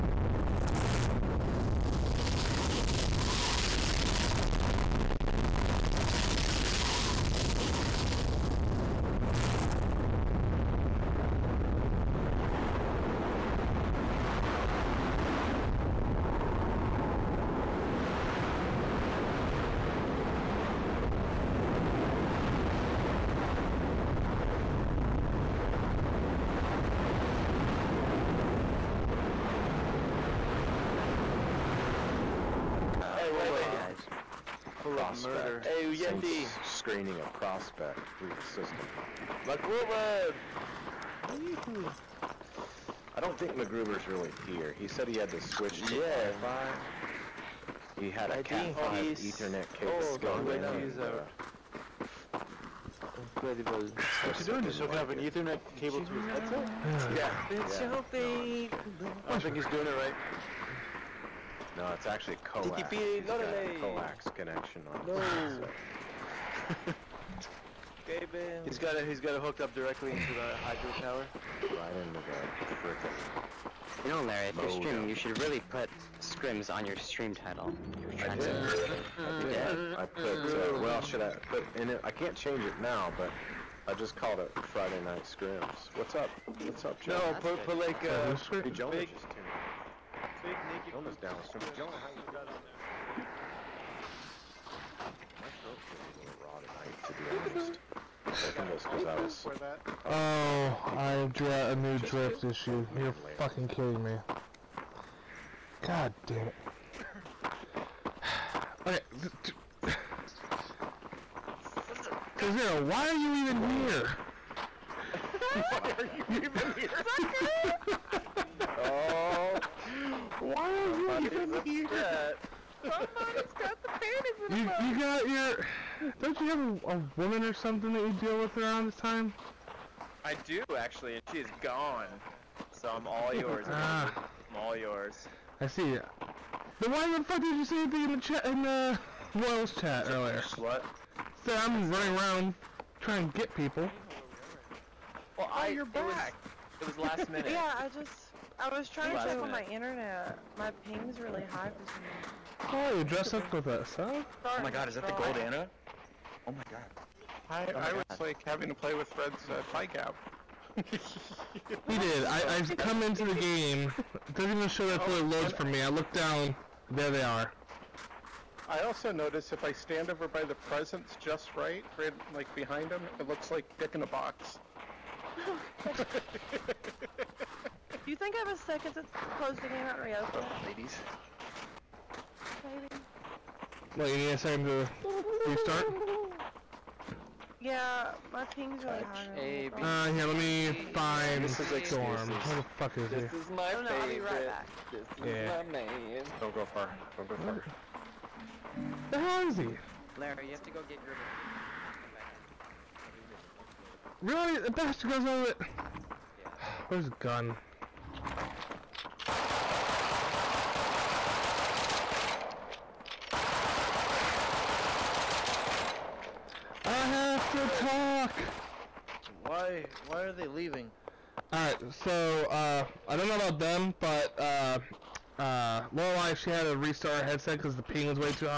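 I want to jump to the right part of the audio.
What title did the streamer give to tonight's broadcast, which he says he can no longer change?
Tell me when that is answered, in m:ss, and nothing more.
1:24.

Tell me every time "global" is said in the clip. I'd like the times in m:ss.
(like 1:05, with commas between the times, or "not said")
not said.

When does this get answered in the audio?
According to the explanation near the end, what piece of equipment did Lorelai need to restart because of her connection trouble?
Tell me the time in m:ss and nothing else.
3:46.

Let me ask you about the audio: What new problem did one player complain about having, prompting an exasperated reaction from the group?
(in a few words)
drift issue.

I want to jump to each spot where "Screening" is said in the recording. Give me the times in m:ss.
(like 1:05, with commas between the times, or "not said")
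0:36.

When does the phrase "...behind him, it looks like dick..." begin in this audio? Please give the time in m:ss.
2:52.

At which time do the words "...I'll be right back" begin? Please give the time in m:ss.
3:13.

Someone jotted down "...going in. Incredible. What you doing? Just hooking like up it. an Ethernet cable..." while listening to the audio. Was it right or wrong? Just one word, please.
right.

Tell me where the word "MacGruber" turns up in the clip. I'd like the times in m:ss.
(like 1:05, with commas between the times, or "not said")
0:39, 0:43.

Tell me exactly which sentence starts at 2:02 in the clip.
Somebody's got the panties in you, You got your...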